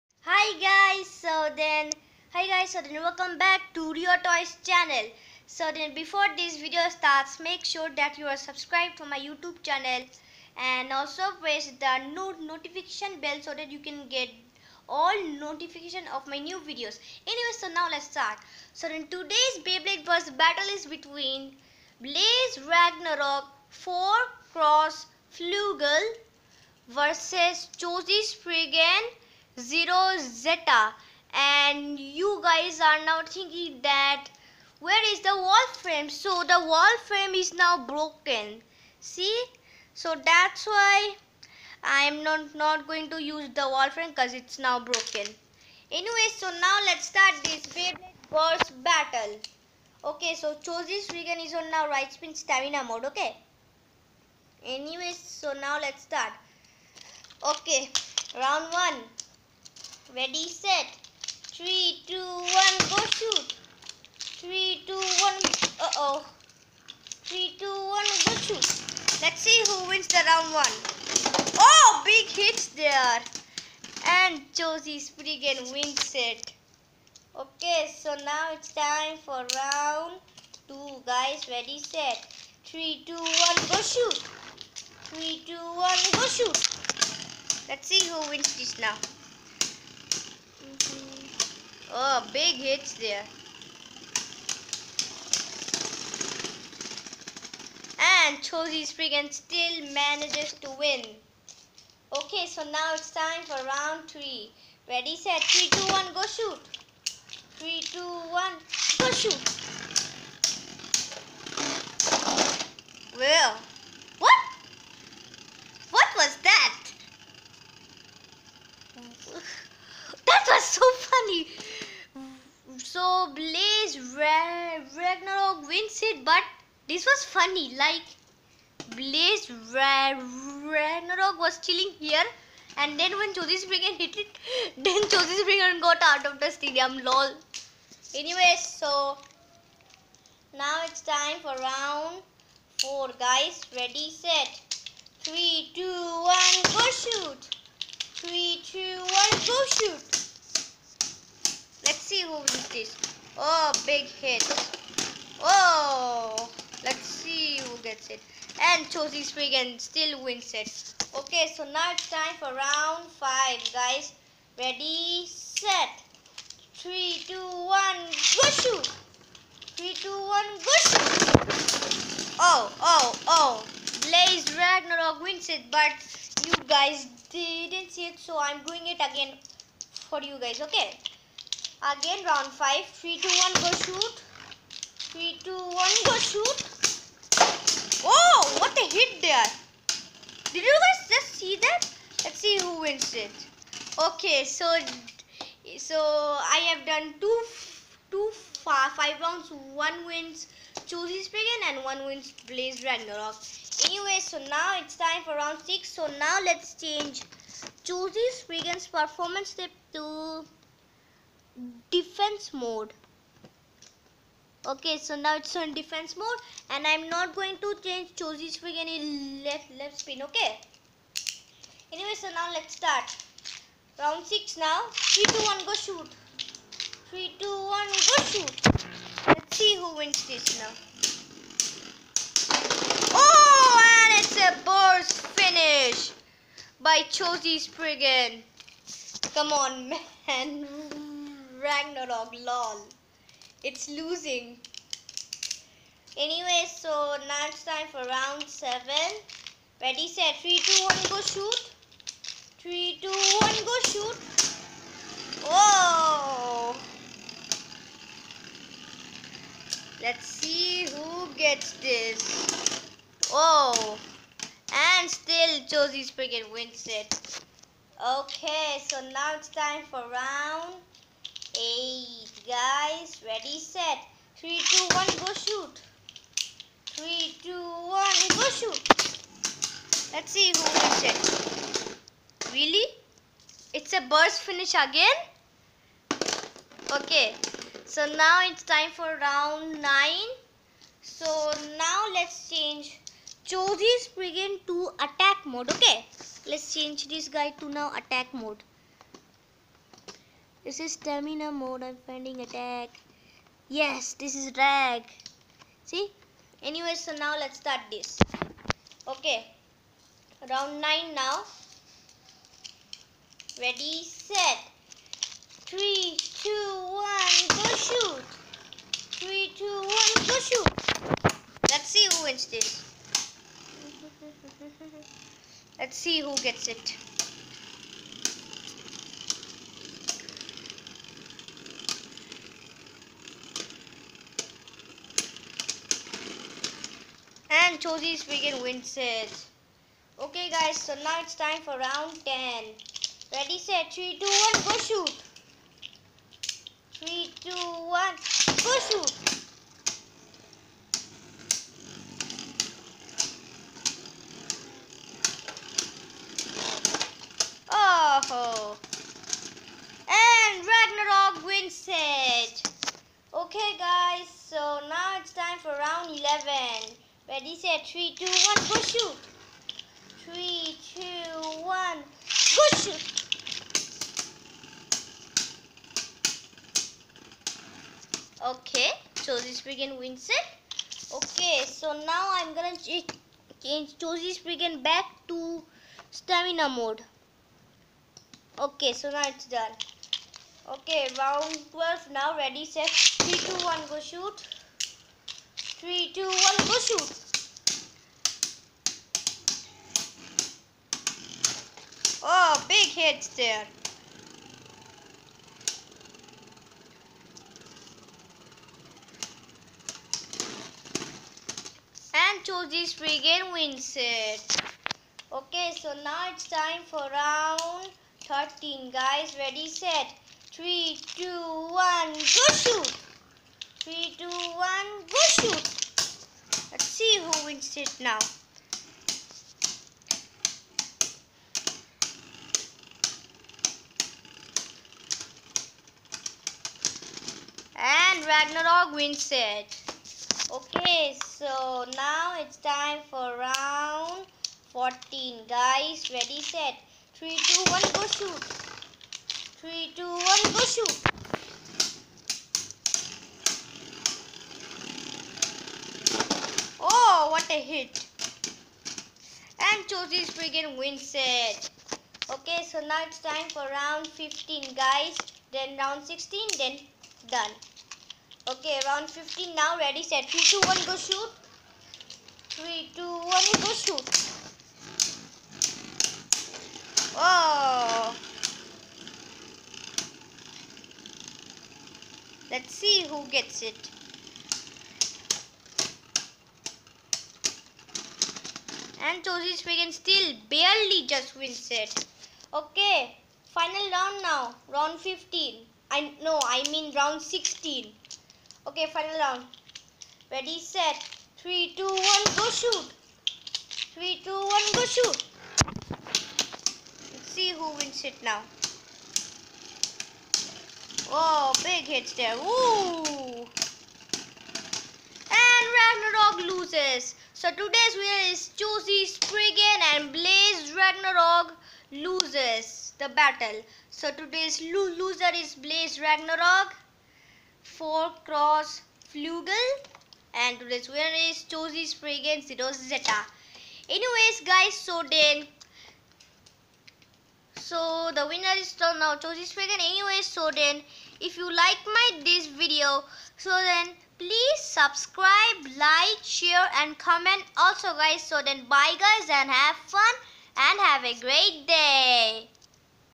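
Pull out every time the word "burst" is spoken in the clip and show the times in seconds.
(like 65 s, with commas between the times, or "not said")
234 s, 284 s.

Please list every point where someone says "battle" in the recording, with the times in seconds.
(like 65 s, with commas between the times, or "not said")
20 s, 48 s, 523 s.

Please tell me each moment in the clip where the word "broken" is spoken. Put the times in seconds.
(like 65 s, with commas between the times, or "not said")
37 s, 44 s.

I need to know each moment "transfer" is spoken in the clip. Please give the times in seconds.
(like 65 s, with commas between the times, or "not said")
not said.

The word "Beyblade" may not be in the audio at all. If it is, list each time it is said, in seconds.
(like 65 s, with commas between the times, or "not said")
19 s, 47 s.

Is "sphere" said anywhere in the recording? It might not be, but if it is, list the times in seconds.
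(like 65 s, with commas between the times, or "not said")
not said.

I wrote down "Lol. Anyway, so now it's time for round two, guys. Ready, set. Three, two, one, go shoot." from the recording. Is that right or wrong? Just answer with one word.
wrong.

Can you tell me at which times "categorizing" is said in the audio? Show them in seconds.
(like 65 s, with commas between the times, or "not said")
not said.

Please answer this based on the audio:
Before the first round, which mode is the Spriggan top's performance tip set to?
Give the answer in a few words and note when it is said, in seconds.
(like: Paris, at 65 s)
Right spin stamina mode, at 51 s.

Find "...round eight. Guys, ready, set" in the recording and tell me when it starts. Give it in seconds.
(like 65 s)
270 s.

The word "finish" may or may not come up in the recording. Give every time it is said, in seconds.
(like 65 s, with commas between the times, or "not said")
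235 s, 284 s.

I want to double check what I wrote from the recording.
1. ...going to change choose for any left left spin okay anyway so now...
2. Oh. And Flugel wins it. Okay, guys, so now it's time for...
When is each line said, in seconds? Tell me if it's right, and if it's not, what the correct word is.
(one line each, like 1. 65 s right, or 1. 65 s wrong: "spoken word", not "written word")
1. 217 s right
2. 358 s wrong: "Ragnaruk", not "Flugel".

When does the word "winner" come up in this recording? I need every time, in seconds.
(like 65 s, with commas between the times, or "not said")
517 s, 530 s, 538 s.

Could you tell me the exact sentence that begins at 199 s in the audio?
One wins Cho Z Spriggan and one wins Blaze Ragnaruk.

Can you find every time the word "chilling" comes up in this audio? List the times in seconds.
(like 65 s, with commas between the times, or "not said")
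131 s.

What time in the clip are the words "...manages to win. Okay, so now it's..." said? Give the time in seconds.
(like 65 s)
99 s.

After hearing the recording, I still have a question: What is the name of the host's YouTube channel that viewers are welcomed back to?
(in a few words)
Rio Toys.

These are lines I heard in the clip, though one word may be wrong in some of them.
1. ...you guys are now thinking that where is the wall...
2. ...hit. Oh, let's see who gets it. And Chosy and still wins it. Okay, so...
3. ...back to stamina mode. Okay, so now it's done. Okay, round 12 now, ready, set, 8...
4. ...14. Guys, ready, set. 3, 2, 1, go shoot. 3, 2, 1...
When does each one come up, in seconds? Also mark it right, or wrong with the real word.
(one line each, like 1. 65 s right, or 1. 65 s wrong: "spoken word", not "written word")
1. 31 s right
2. 154 s right
3. 384 s wrong: "3", not "8"
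4. 444 s right.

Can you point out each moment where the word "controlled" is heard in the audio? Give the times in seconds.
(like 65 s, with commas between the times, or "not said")
not said.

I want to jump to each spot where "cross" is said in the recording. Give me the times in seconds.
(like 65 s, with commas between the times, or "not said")
24 s, 528 s.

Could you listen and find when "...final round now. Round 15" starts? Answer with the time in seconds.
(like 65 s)
493 s.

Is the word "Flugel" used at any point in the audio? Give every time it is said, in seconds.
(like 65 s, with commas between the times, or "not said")
25 s, 529 s.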